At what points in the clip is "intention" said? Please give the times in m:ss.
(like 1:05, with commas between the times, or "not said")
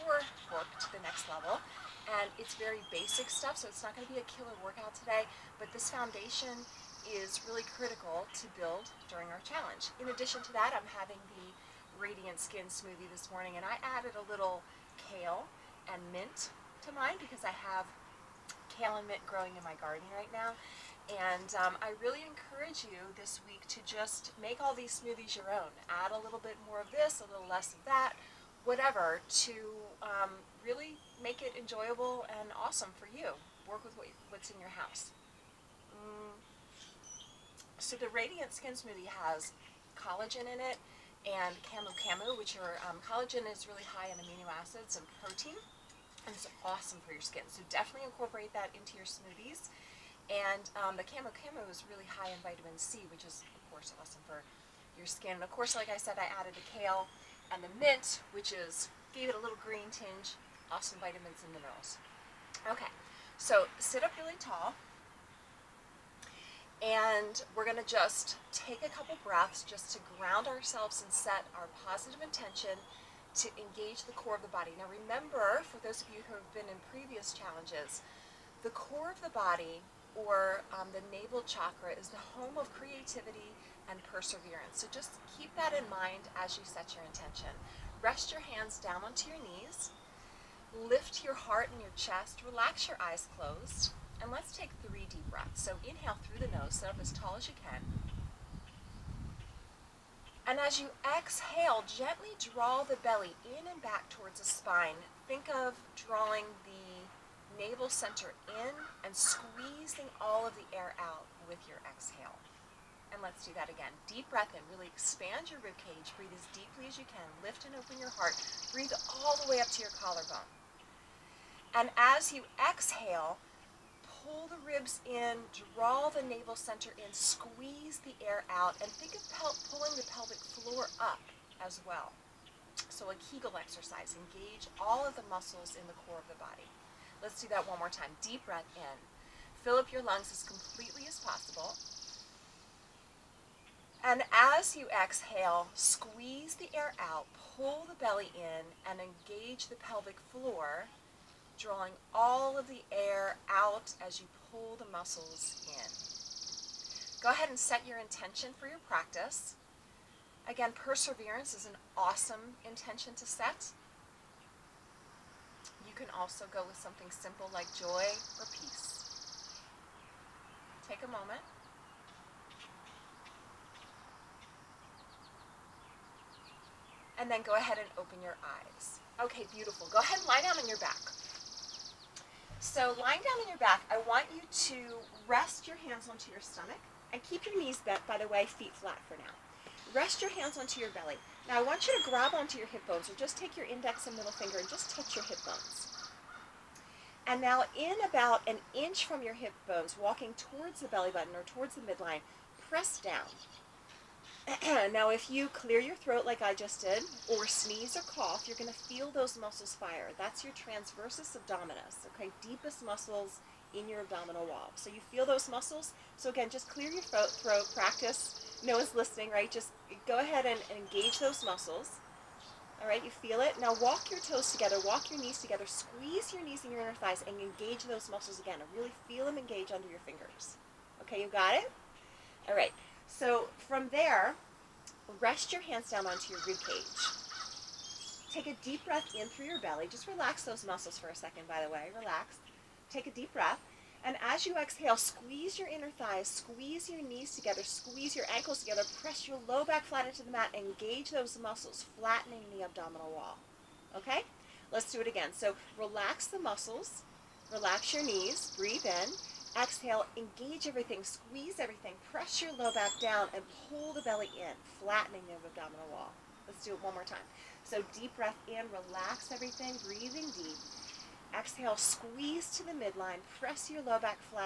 1:12, 1:27, 2:37, 2:42.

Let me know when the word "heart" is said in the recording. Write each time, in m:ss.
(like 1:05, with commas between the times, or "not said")
1:31, 1:58.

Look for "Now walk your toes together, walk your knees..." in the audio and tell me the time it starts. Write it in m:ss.
3:43.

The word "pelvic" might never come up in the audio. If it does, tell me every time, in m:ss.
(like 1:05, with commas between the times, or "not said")
2:10, 2:29.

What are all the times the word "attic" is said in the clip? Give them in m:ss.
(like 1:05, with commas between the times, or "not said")
not said.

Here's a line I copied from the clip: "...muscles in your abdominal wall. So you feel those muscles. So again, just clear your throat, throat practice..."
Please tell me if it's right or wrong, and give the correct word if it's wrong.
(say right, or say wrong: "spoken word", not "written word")
right.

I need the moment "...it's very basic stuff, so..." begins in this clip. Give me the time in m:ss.
0:02.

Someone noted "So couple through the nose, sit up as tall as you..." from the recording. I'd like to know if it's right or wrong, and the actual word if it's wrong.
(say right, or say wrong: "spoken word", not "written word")
wrong: "inhale", not "couple".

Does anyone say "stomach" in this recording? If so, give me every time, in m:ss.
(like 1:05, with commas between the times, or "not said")
3:06.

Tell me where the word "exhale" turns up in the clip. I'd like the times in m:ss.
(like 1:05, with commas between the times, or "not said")
1:41, 1:51, 2:02, 2:24, 4:04, 4:19, 4:31.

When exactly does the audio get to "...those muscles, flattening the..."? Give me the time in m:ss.
4:11.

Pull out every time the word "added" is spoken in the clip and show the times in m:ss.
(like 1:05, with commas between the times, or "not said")
0:13, 0:56.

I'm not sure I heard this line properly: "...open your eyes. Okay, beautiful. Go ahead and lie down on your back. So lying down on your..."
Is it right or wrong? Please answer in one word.
right.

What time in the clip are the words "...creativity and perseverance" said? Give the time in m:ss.
1:22.